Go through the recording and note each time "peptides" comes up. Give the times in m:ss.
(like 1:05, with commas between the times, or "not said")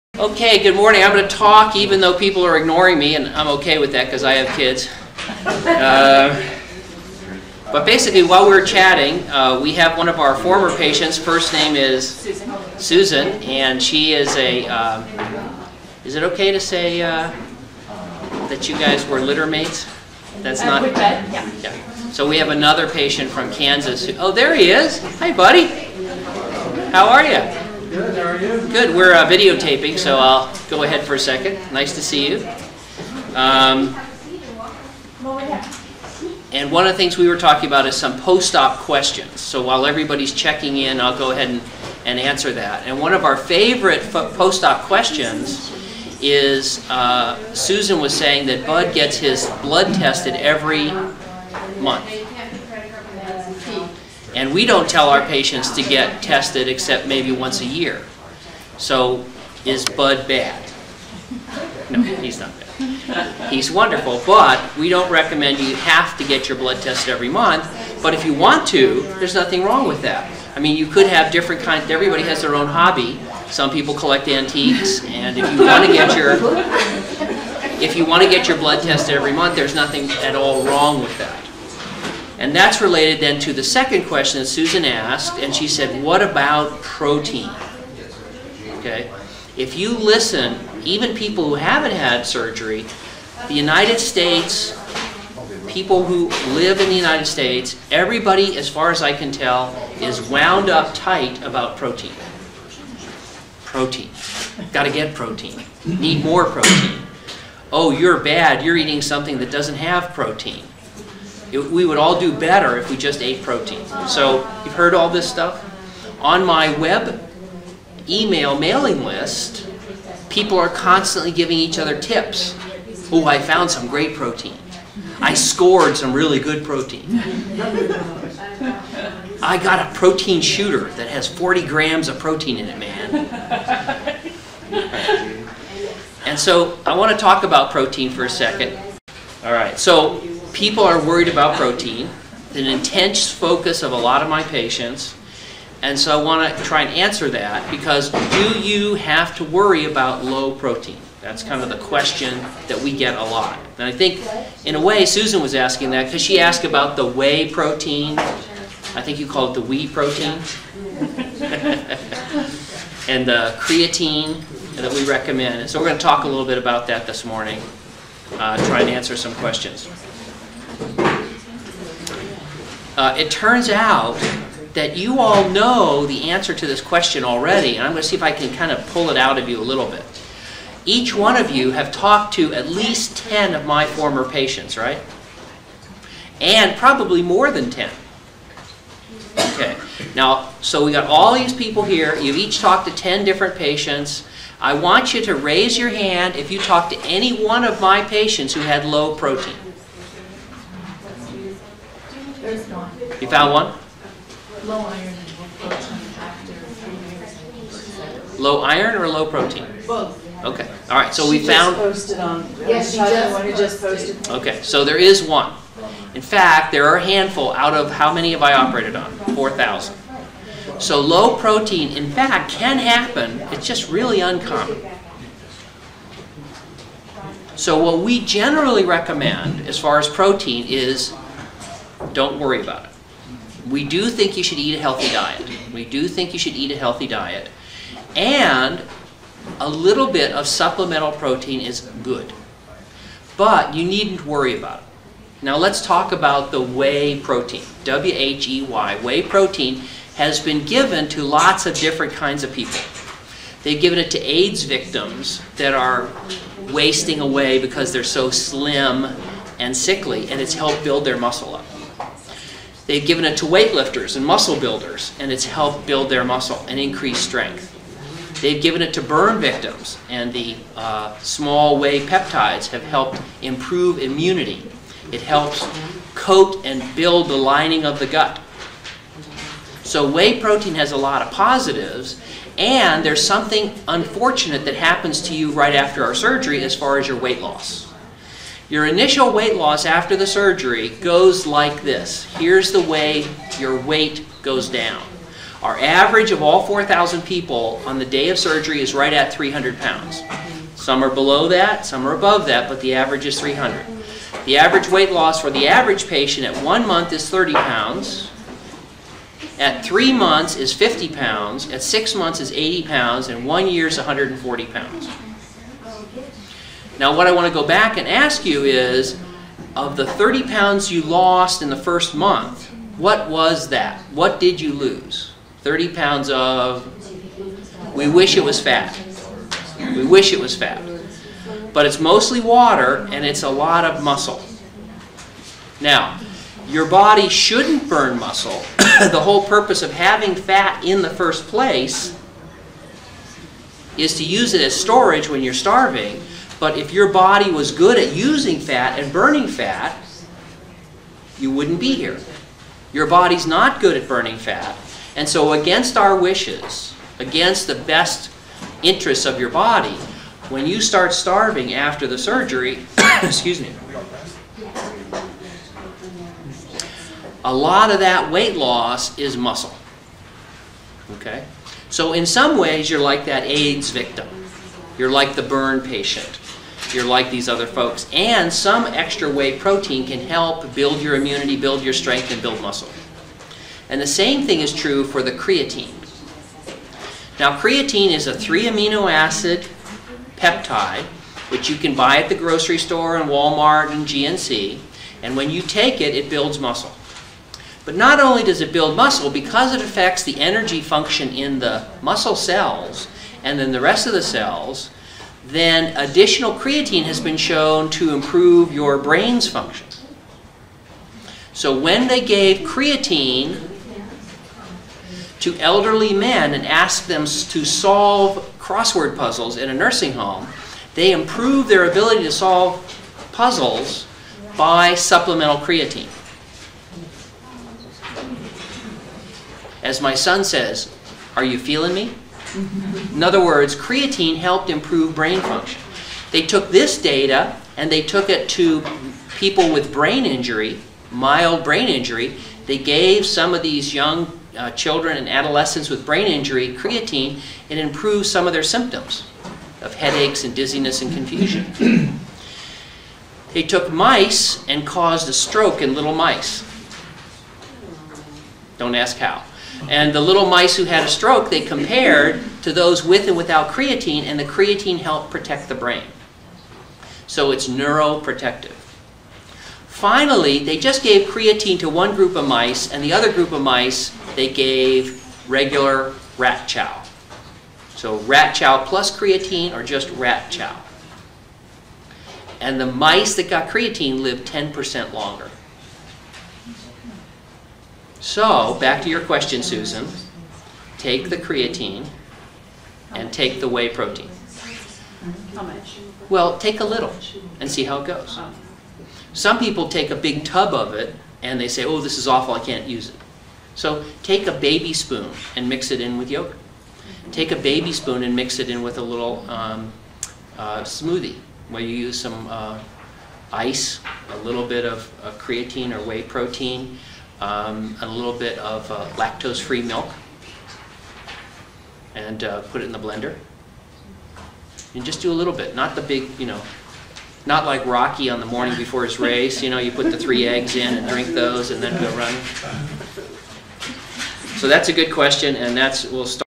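4:32, 6:30.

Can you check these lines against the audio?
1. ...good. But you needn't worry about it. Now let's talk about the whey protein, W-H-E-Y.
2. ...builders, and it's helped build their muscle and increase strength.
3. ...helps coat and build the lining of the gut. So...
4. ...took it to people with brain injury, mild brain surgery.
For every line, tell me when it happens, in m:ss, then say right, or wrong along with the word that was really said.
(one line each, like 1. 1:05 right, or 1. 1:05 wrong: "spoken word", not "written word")
1. 4:02 right
2. 4:24 right
3. 4:35 right
4. 7:18 wrong: "injury", not "surgery".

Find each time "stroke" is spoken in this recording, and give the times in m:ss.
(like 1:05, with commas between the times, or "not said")
7:35, 7:41.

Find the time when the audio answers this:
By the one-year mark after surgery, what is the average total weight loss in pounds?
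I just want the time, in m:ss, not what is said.
5:13.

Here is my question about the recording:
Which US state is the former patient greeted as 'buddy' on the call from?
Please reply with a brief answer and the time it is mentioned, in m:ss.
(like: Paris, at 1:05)
Kansas, at 0:23.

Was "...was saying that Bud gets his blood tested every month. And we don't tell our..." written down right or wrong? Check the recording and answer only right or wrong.
right.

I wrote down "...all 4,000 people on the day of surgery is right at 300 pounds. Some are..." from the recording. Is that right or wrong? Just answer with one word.
right.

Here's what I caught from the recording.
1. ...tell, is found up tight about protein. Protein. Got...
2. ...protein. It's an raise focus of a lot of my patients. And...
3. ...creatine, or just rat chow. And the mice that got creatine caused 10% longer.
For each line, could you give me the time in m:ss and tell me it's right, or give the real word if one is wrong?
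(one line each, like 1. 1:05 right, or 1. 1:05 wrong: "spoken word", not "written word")
1. 1:39 wrong: "wound", not "found"
2. 2:21 wrong: "intense", not "raise"
3. 7:59 wrong: "lived", not "caused".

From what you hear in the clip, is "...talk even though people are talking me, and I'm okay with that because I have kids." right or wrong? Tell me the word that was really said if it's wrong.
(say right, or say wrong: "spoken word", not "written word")
wrong: "ignoring", not "talking".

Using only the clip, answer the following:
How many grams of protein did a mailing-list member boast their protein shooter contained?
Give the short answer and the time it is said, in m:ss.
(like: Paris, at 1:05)
40, at 2:11.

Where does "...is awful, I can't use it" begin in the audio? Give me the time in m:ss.
8:22.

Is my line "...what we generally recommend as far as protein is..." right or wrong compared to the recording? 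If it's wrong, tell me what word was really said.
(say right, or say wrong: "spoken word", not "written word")
right.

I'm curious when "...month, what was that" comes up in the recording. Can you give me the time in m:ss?
5:22.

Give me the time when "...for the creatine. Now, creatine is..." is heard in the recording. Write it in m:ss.
6:25.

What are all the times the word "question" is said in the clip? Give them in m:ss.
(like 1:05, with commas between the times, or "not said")
0:38, 0:44, 1:24, 2:31, 2:49, 2:56, 8:09, 8:55.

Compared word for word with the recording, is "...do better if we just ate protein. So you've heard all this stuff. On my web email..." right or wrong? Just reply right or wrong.
right.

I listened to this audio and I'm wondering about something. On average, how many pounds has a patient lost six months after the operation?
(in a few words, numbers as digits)
80.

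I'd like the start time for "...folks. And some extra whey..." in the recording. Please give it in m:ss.
6:17.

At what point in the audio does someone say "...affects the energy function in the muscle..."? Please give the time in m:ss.
6:39.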